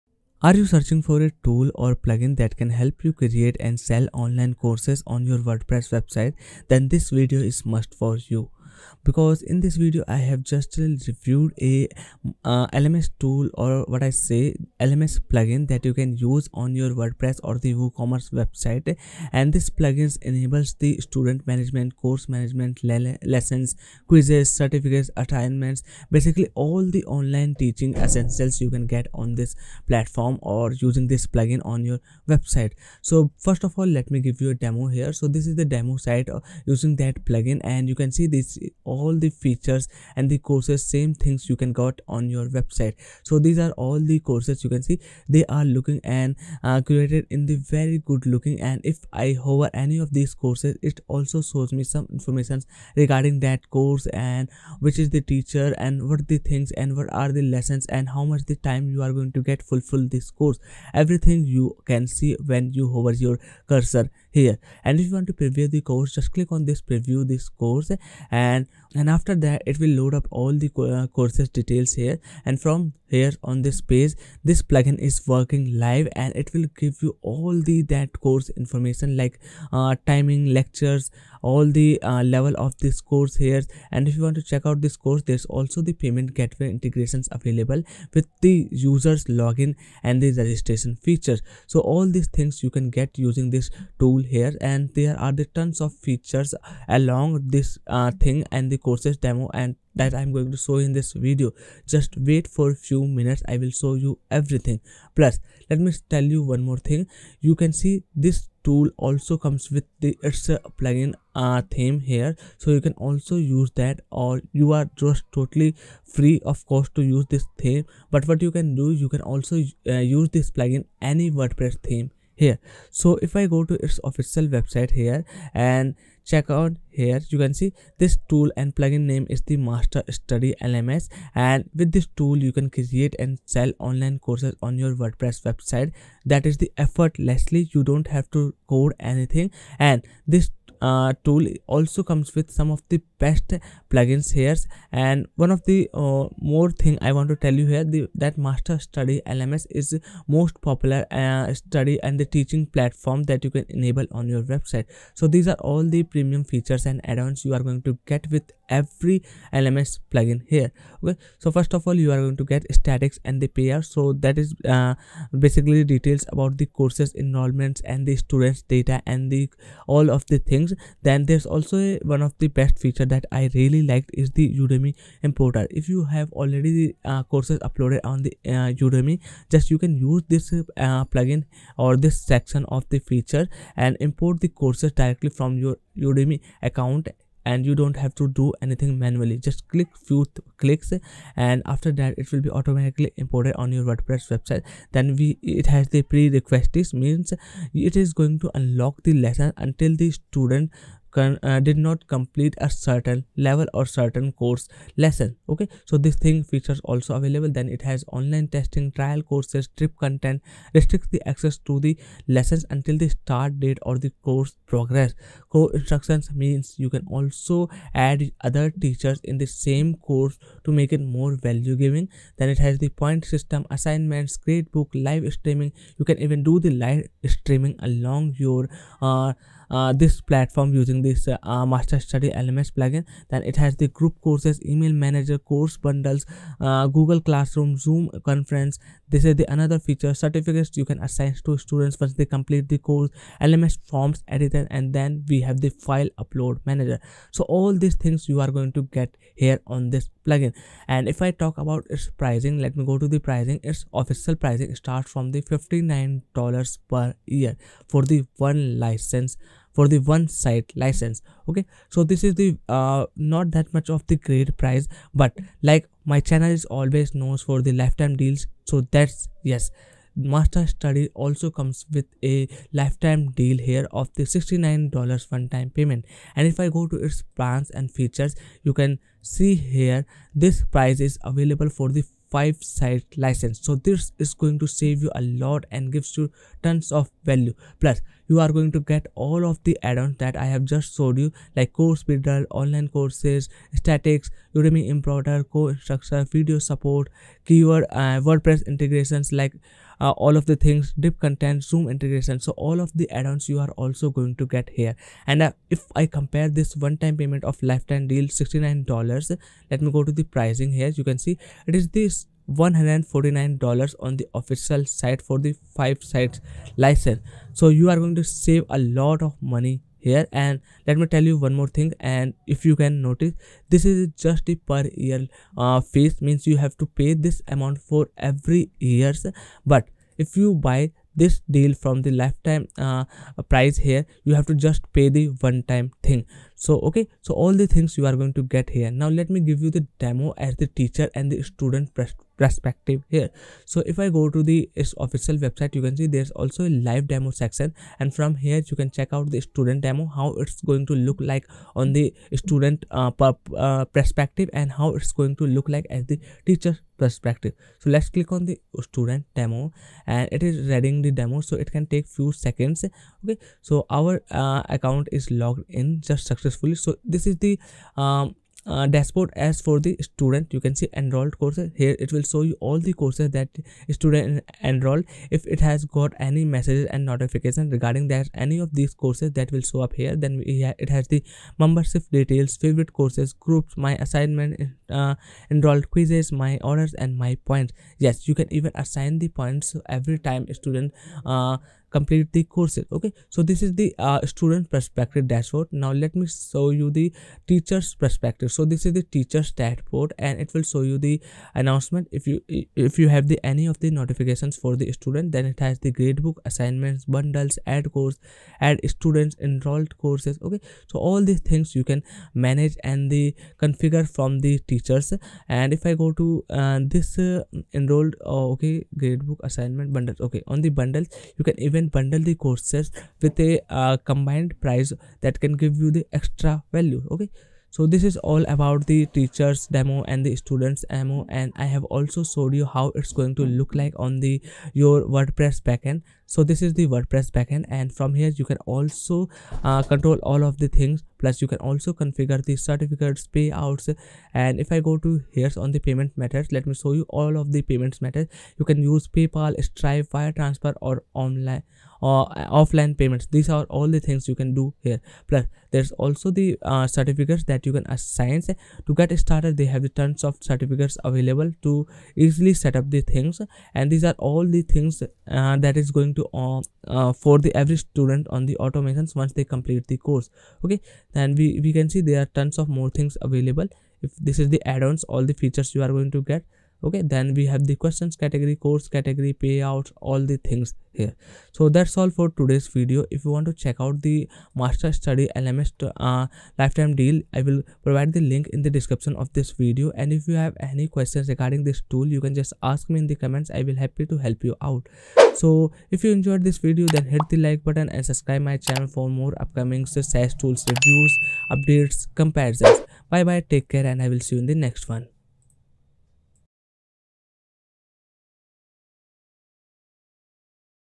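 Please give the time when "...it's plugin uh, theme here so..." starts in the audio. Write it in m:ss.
1:50.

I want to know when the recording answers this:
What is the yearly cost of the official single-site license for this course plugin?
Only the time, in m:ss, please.
4:15.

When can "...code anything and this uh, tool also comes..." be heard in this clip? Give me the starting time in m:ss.
2:18.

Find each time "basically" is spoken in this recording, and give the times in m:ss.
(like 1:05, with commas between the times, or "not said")
0:26, 2:45.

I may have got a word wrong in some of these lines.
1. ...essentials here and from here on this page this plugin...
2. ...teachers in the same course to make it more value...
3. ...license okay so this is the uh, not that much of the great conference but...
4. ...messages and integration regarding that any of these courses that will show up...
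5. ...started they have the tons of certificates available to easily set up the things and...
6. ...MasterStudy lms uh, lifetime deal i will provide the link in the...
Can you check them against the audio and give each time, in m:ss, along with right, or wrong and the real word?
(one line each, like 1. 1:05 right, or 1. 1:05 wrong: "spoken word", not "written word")
1. 1:11 wrong: "details", not "essentials"
2. 3:38 right
3. 4:20 wrong: "price", not "conference"
4. 6:16 wrong: "notification", not "integration"
5. 7:39 right
6. 8:04 right.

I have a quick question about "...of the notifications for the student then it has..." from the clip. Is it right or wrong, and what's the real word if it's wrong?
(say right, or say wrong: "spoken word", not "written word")
right.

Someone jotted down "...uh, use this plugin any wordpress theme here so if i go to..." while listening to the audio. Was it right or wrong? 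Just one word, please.
right.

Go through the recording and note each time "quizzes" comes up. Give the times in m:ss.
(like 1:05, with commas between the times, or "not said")
0:24, 6:25.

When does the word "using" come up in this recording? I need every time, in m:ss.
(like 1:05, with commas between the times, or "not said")
0:30, 0:36, 1:33, 3:50.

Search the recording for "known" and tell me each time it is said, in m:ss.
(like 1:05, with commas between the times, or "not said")
4:27.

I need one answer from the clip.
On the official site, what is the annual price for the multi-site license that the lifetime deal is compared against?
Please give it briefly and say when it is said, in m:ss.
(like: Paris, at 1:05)
$149, at 5:12.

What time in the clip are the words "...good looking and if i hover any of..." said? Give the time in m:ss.
0:48.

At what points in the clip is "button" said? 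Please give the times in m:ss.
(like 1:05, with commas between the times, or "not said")
8:17.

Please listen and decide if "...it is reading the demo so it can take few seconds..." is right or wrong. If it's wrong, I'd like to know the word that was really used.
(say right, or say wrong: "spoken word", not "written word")
right.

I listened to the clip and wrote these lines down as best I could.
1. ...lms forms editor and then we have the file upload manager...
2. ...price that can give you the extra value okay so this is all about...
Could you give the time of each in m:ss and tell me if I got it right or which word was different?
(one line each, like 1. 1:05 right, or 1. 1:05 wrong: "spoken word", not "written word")
1. 4:03 right
2. 7:04 right.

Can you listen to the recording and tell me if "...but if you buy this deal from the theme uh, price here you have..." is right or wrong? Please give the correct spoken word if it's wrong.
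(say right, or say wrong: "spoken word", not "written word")
wrong: "lifetime", not "theme".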